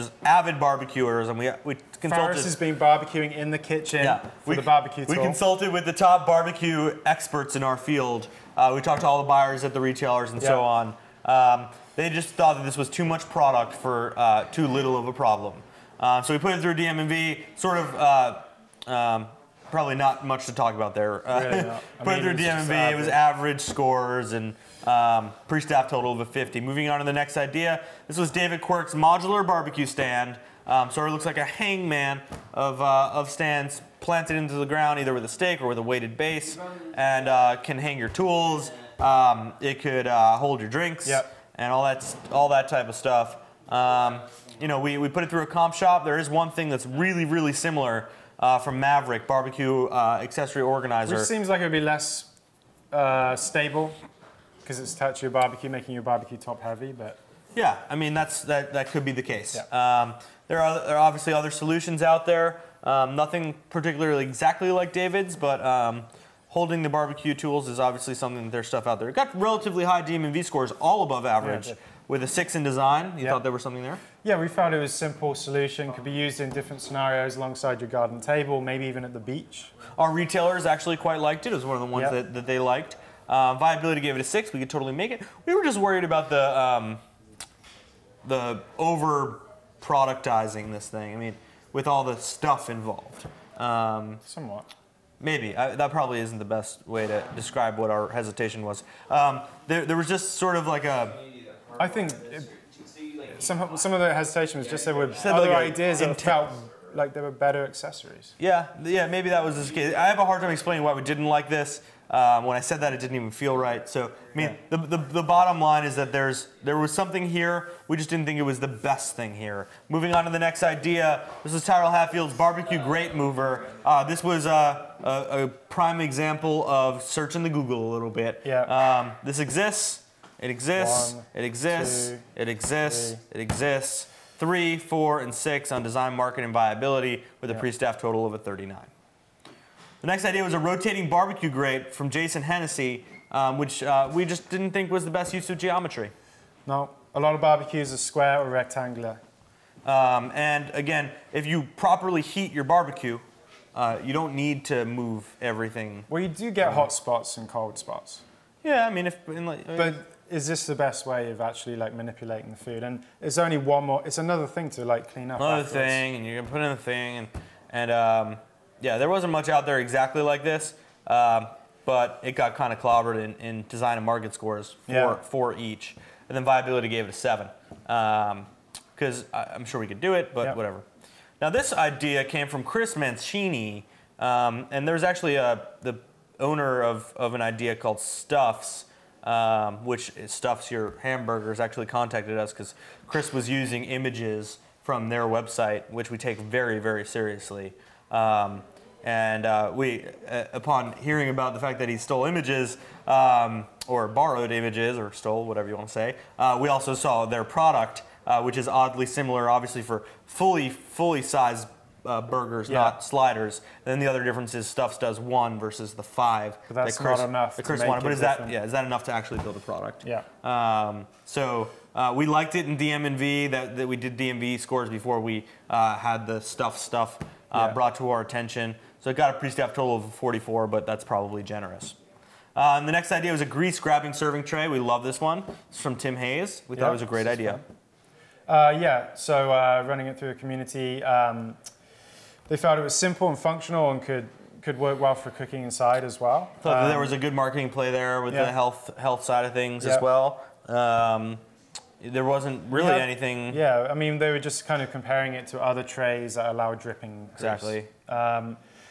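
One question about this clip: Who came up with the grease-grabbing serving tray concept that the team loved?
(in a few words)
Tim Hayes.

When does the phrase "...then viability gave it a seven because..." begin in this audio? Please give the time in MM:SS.
02:56.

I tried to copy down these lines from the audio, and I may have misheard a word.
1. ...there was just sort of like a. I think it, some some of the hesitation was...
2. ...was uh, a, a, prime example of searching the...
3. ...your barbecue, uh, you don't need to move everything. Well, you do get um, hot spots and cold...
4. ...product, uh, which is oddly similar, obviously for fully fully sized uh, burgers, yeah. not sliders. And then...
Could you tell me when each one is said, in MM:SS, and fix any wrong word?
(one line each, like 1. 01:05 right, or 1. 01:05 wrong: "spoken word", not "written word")
1. 01:39 right
2. 02:04 right
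3. 02:32 right
4. 03:27 right.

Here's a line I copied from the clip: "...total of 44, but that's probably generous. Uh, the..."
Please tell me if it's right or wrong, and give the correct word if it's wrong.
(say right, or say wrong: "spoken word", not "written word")
right.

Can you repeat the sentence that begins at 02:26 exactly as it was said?
No, a lot of barbecues are square or rectangular.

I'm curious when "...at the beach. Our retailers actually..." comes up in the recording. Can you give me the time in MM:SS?
01:19.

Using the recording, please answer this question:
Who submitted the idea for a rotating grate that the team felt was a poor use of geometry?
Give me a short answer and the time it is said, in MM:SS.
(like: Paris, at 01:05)
Jason Hennessy, at 02:22.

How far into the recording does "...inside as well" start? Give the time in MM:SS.
04:05.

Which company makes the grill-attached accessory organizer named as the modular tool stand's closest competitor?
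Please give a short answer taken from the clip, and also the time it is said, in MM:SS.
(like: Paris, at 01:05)
Maverick, at 00:48.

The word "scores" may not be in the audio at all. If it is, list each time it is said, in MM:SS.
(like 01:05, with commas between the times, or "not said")
00:23, 01:10, 02:54, 03:44.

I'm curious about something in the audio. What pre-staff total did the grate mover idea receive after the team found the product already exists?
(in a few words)
39.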